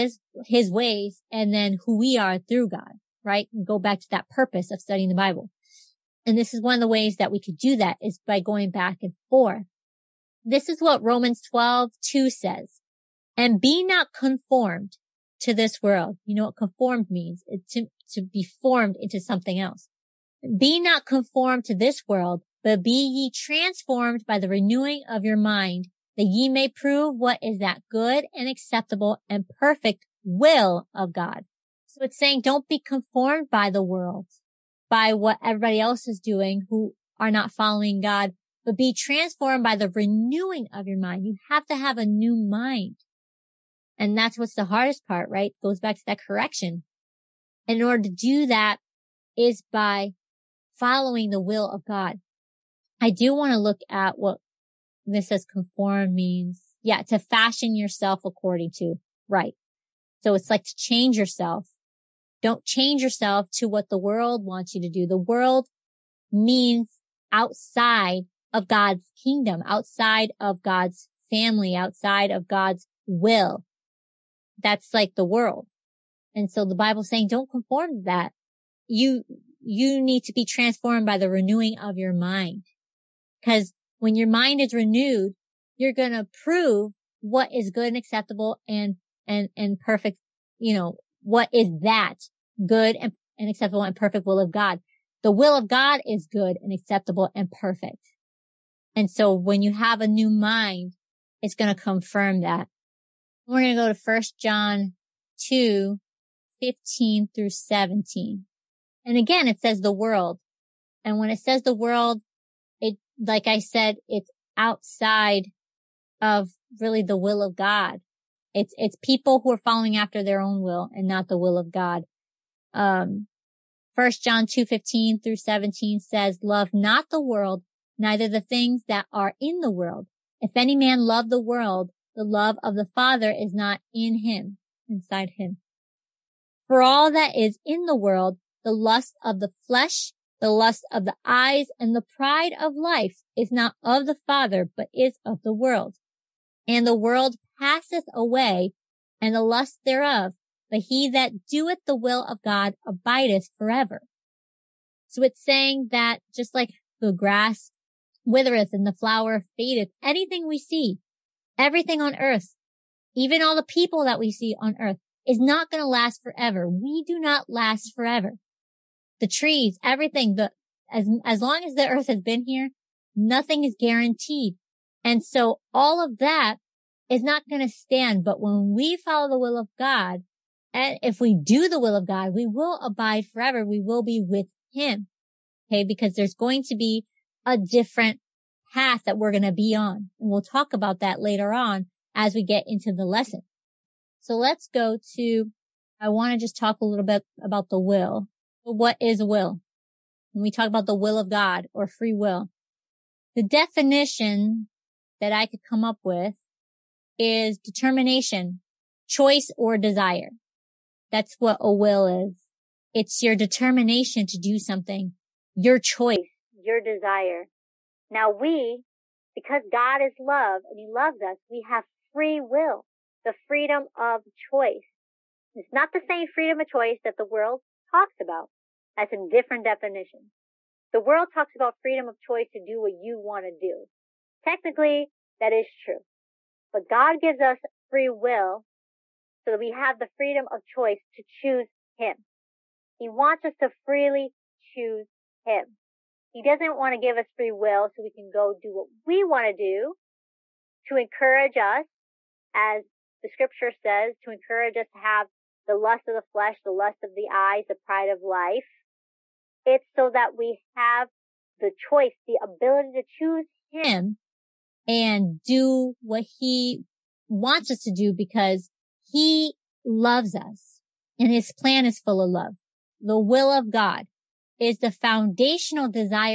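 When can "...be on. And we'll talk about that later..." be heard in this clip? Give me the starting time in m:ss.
3:09.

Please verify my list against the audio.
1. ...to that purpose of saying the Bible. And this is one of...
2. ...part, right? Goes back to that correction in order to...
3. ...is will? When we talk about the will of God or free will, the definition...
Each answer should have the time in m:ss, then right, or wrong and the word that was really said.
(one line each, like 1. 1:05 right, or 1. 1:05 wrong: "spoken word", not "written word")
1. 0:04 wrong: "studying", not "saying"
2. 0:45 right
3. 3:19 right.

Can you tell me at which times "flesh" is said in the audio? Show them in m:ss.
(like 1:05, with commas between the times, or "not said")
2:19, 4:16.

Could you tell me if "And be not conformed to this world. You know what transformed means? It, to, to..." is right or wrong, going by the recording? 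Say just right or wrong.
wrong.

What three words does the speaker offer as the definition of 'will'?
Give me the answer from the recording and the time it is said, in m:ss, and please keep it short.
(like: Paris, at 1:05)
Determination, choice or desire, at 3:27.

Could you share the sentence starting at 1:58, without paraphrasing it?
It's, it's people who are following after their own will and not the will of God.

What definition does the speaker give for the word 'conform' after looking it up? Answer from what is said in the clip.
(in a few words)
To fashion yourself.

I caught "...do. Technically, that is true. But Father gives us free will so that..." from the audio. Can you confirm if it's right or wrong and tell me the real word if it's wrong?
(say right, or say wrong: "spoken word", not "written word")
wrong: "God", not "Father".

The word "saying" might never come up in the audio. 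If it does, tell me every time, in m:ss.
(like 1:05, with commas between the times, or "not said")
0:32, 1:17, 2:35.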